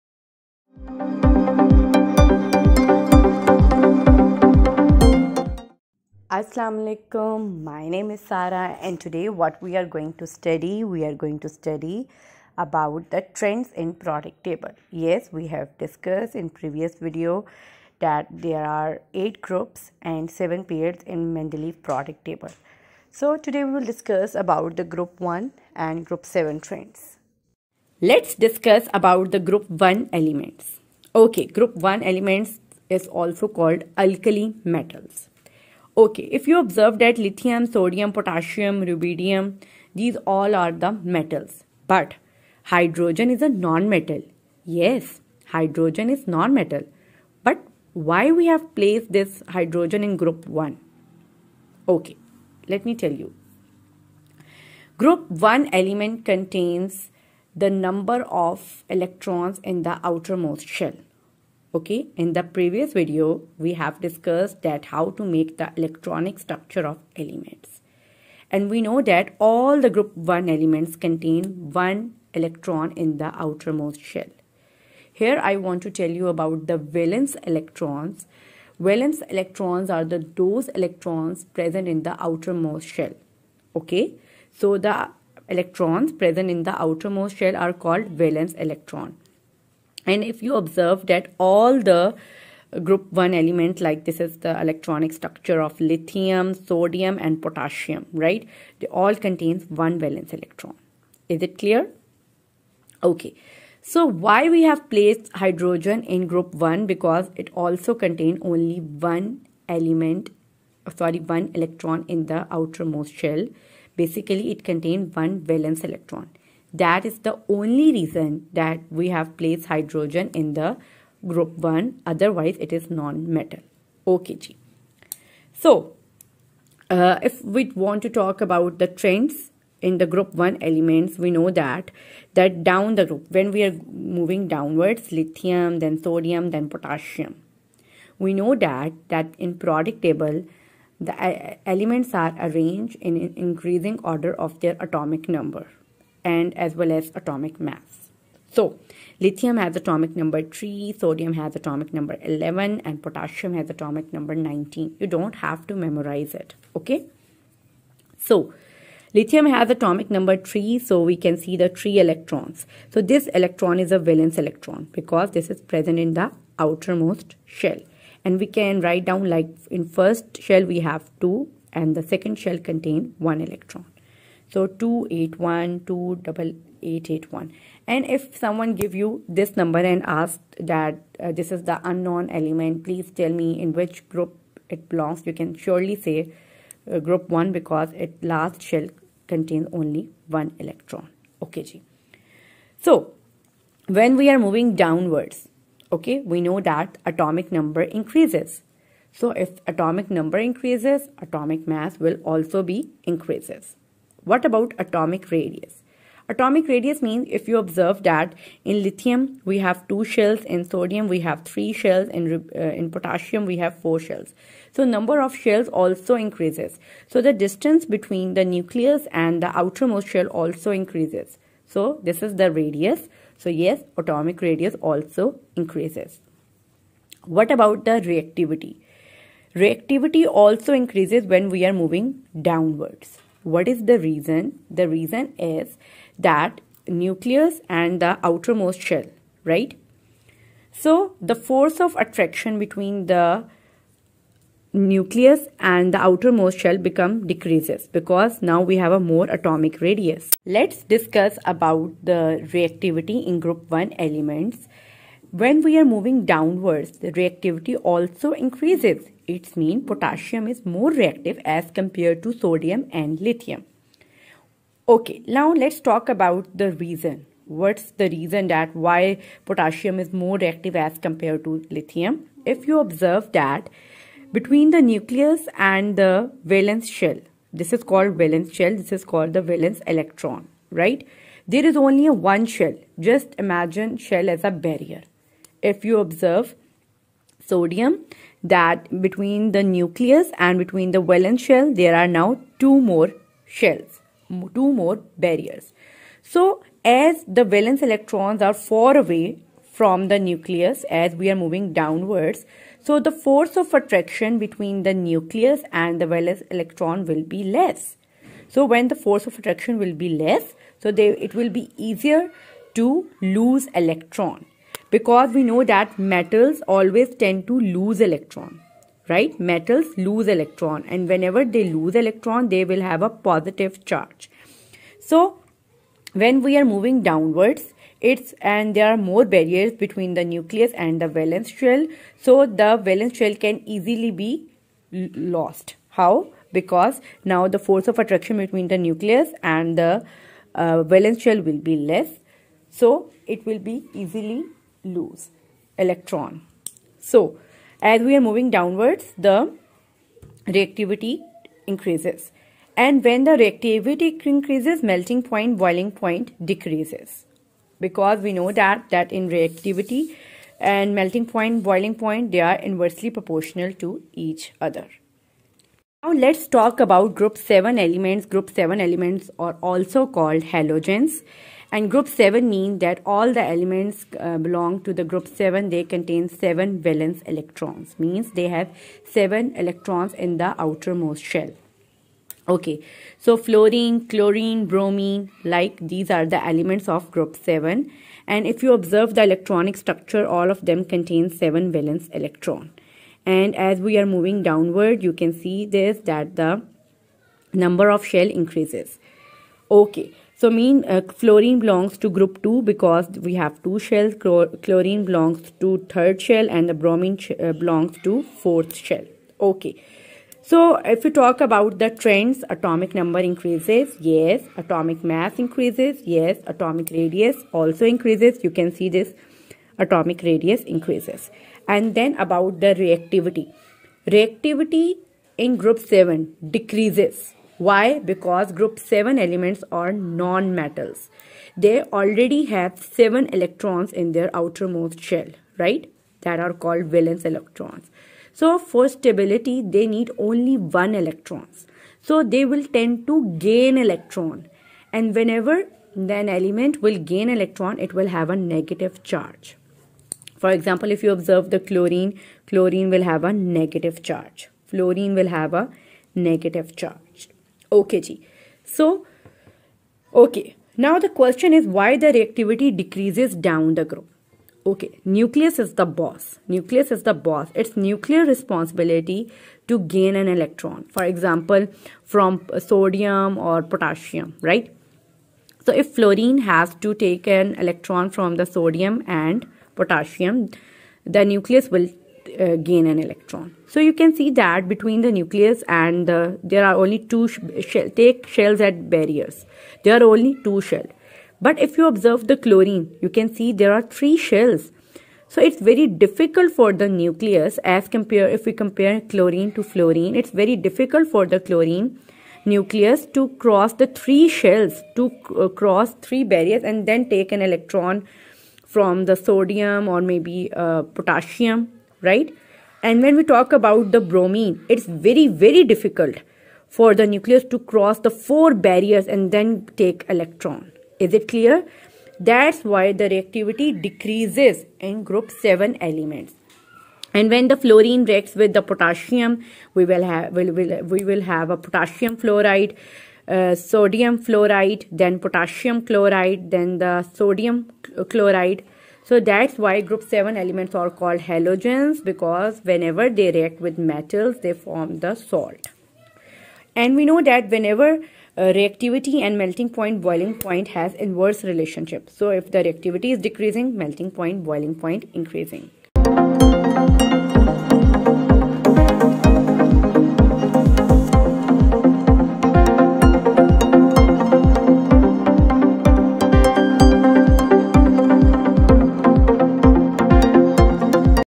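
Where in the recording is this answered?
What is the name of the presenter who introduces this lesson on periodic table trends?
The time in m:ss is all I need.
0:08.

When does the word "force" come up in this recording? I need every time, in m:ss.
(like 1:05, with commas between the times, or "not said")
4:01, 5:03, 5:09, 5:37.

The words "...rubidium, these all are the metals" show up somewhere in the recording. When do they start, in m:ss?
0:38.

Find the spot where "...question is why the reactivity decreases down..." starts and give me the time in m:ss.
7:41.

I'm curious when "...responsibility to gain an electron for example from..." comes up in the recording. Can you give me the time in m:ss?
7:48.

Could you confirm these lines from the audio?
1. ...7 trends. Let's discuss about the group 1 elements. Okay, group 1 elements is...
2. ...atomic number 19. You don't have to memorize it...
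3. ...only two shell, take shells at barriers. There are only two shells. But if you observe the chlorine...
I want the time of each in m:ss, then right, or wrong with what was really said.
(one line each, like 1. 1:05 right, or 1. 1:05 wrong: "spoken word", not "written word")
1. 0:26 right
2. 2:33 right
3. 8:06 right.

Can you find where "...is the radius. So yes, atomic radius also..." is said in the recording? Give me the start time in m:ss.
3:42.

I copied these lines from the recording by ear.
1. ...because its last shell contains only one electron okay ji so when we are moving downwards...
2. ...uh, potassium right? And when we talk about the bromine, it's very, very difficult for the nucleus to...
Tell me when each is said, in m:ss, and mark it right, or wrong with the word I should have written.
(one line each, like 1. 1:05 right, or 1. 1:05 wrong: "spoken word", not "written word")
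1. 3:07 right
2. 8:30 right.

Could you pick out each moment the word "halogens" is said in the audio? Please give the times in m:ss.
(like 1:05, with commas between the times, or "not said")
6:10, 9:01.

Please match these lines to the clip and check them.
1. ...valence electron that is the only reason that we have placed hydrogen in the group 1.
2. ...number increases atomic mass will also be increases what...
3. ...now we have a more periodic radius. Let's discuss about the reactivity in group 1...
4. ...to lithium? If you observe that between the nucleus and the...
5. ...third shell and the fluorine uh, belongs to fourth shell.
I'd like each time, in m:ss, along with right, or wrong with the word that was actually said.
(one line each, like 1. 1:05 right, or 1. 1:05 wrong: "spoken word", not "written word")
1. 1:55 right
2. 3:20 right
3. 4:08 wrong: "atomic", not "periodic"
4. 4:31 right
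5. 6:45 wrong: "bromine", not "fluorine".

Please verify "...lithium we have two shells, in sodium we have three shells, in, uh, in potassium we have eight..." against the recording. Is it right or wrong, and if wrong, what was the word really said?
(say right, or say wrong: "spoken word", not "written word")
wrong: "four", not "eight".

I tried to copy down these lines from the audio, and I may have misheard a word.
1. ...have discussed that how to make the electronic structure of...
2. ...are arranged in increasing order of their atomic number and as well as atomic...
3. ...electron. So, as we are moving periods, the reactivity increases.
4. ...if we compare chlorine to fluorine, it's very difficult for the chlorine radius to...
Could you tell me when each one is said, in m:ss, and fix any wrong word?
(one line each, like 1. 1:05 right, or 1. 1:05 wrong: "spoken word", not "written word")
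1. 1:03 right
2. 2:22 right
3. 5:45 wrong: "downwards", not "periods"
4. 8:18 wrong: "nucleus", not "radius".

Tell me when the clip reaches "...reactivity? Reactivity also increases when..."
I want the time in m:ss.
3:48.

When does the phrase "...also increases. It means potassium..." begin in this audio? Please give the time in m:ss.
4:17.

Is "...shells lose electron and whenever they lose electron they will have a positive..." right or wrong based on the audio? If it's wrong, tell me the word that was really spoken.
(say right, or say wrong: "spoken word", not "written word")
wrong: "metals", not "shells".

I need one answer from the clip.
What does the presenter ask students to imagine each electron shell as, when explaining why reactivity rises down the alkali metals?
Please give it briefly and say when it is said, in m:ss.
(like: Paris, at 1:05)
A barrier, at 4:44.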